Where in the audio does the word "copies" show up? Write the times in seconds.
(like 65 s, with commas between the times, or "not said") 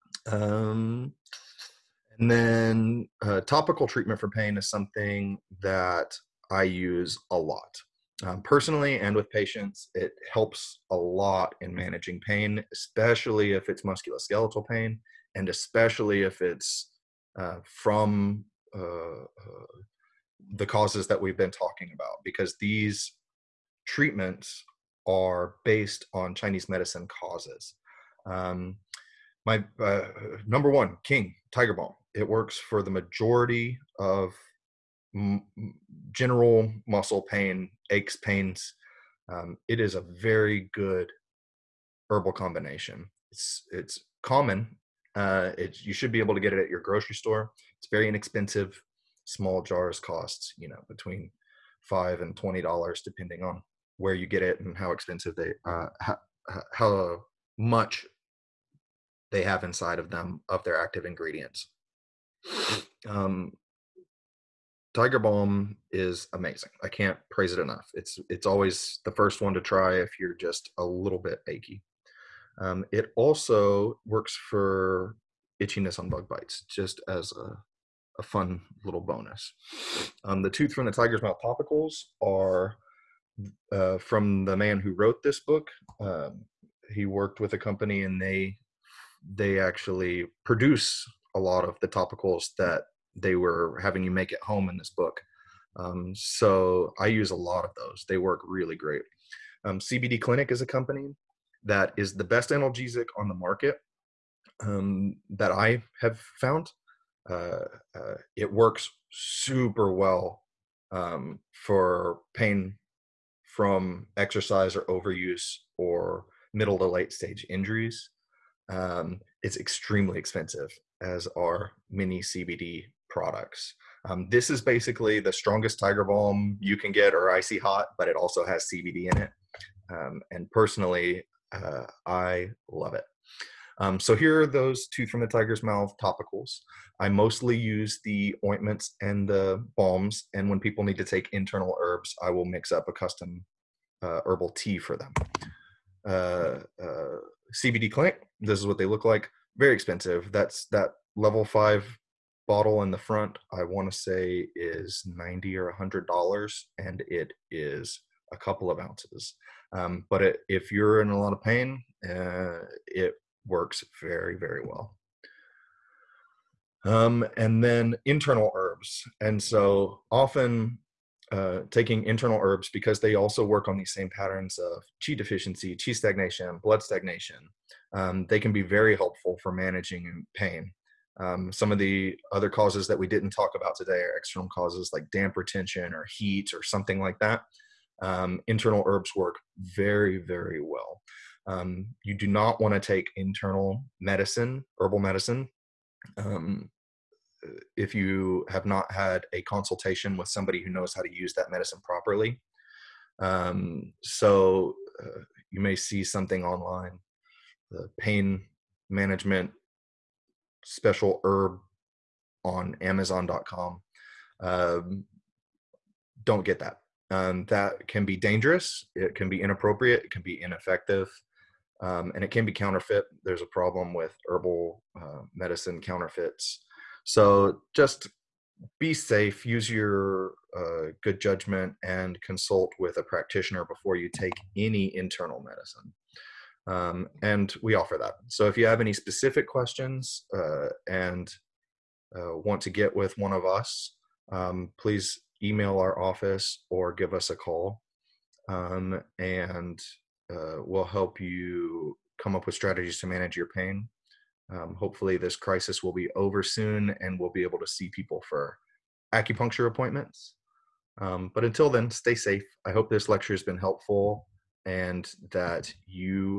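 not said.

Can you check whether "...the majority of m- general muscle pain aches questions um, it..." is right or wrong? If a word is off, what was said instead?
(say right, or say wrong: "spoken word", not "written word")
wrong: "pains", not "questions".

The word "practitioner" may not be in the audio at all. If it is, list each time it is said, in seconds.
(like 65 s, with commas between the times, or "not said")
233 s.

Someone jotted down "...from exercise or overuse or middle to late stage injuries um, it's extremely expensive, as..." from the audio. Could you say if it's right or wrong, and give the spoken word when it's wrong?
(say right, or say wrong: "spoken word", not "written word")
right.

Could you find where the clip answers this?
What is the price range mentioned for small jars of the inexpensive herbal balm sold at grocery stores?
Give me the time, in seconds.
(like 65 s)
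50 s.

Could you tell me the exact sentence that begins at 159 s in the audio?
Um, but it, if you're in a lot of pain, uh, it works very very well.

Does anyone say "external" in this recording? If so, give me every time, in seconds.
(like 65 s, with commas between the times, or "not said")
184 s.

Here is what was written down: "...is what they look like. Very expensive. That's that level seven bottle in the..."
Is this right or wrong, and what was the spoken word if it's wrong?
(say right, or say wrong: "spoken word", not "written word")
wrong: "five", not "seven".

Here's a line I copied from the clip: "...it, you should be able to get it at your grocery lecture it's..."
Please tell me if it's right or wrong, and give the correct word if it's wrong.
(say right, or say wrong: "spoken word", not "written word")
wrong: "store", not "lecture".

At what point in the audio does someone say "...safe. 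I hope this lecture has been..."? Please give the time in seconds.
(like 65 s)
262 s.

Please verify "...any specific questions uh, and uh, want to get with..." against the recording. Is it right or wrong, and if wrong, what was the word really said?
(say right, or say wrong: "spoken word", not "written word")
right.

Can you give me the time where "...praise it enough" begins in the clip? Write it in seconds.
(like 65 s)
67 s.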